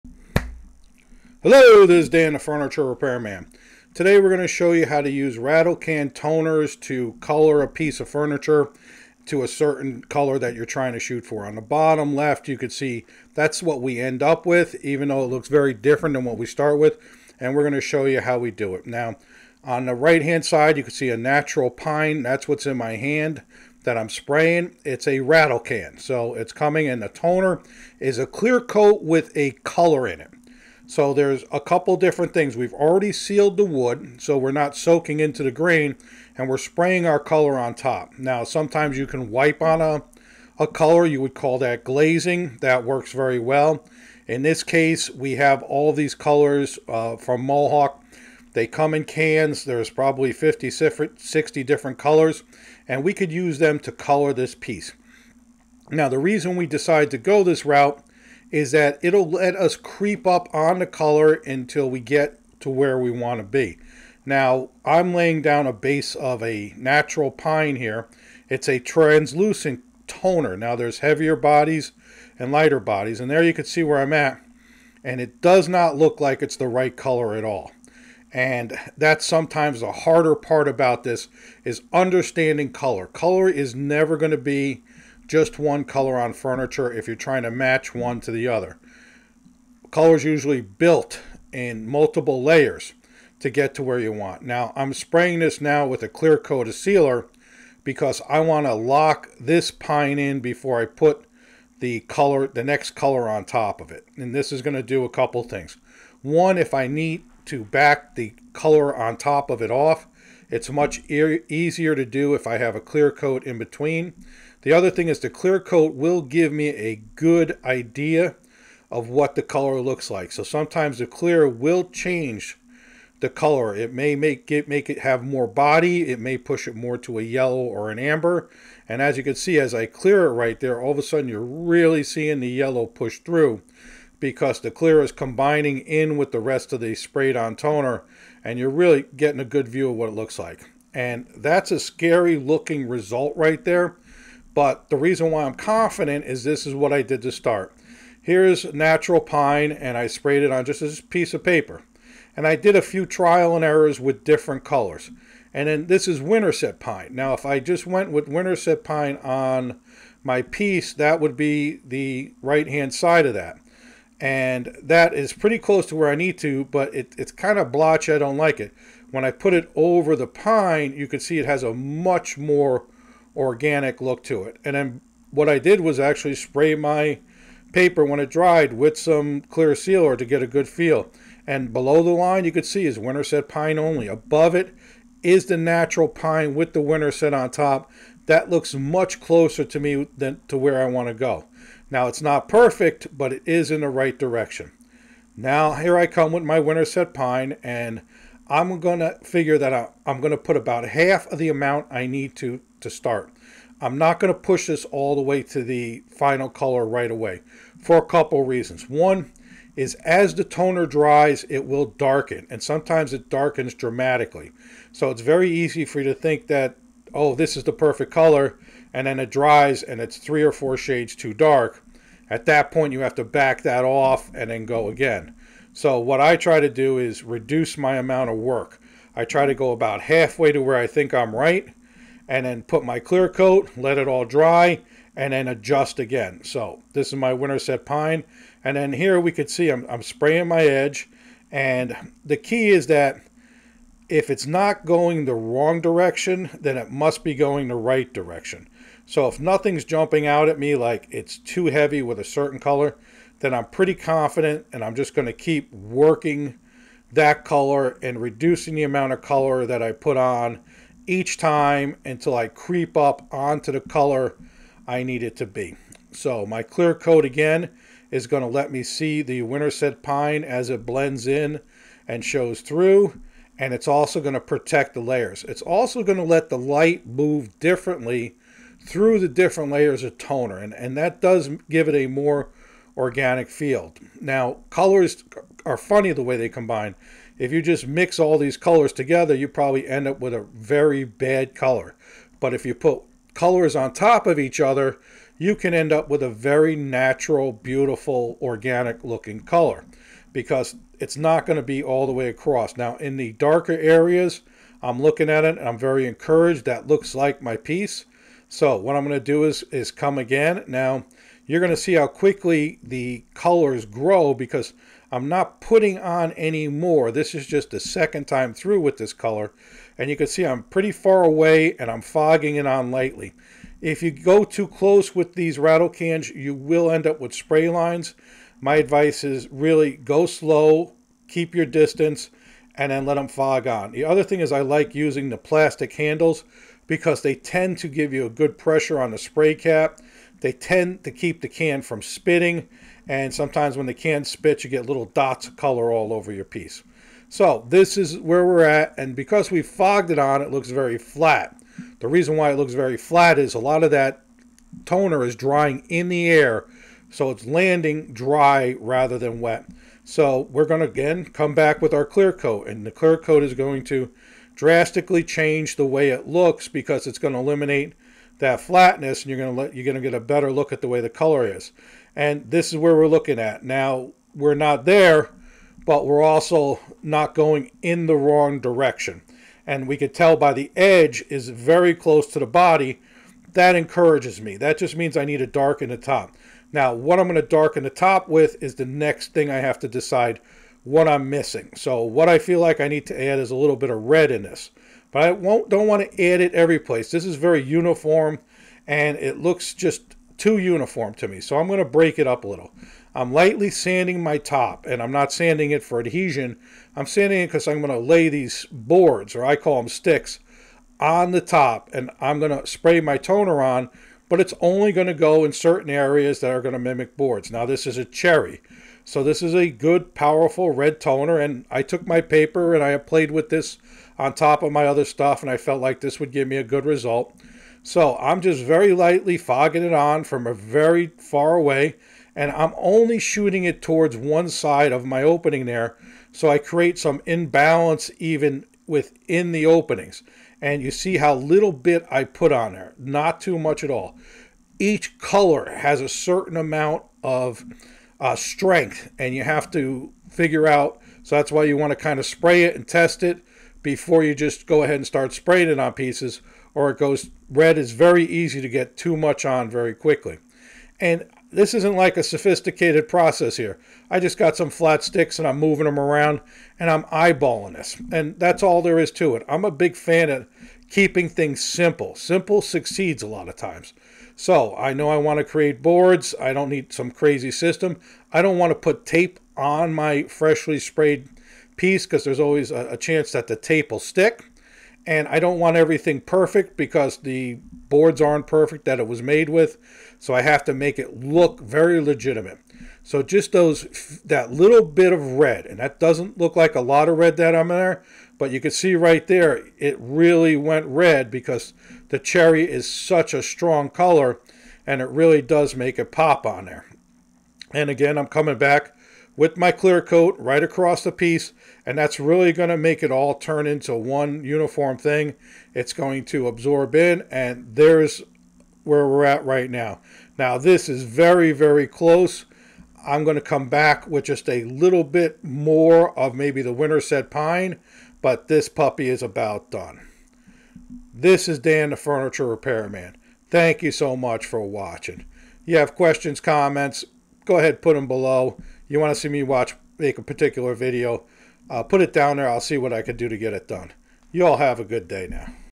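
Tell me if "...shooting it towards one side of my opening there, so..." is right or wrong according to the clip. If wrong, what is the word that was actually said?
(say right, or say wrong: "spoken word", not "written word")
right.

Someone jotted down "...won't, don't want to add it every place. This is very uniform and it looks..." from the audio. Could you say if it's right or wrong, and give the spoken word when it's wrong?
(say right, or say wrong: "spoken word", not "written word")
right.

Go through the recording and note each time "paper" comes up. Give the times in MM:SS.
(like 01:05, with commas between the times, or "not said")
02:31, 02:57, 07:02.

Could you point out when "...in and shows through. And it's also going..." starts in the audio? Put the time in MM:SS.
04:31.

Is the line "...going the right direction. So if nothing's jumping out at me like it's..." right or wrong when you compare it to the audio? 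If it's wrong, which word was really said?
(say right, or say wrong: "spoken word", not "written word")
right.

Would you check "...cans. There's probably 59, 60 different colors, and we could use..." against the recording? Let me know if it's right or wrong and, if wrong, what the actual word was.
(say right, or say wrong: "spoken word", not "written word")
wrong: "50", not "59".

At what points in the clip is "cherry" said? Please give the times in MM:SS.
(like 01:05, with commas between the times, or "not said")
06:58, 08:22.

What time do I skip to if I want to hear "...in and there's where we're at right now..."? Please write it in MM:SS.
08:36.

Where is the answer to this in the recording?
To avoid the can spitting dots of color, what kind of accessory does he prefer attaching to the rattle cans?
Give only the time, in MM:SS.
05:35.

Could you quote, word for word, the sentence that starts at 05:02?
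Now, in the darker areas, I'm looking at it I'm very encouraged.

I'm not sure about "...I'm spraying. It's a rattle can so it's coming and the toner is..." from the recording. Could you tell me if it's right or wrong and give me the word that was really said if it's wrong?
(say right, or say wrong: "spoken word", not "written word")
right.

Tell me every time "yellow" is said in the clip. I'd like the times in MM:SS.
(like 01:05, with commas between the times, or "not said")
02:07, 02:12.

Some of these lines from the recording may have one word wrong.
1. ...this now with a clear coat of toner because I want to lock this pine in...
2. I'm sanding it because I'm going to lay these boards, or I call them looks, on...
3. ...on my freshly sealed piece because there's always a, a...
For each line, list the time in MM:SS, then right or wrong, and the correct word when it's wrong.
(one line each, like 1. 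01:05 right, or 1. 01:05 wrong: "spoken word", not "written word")
1. 01:35 wrong: "sealer", not "toner"
2. 06:46 wrong: "sticks", not "looks"
3. 07:59 wrong: "sprayed", not "sealed".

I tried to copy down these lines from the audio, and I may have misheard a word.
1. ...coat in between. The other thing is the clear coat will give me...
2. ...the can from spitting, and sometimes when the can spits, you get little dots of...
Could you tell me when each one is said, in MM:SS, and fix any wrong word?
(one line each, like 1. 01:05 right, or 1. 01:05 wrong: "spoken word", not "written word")
1. 01:53 right
2. 05:41 right.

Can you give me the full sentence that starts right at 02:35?
And then this is winterset pine.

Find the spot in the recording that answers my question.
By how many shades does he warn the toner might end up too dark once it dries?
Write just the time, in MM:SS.
03:40.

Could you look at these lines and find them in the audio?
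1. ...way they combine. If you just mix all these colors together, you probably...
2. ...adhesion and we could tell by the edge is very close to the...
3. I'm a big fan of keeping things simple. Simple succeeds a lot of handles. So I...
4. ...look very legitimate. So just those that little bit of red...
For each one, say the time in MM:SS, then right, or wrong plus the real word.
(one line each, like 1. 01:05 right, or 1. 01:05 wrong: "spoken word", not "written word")
1. 04:46 right
2. 06:18 wrong: "direction", not "adhesion"
3. 07:49 wrong: "times", not "handles"
4. 08:11 right.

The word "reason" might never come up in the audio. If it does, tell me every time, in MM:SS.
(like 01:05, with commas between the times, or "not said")
00:56, 02:24, 03:28, 05:52.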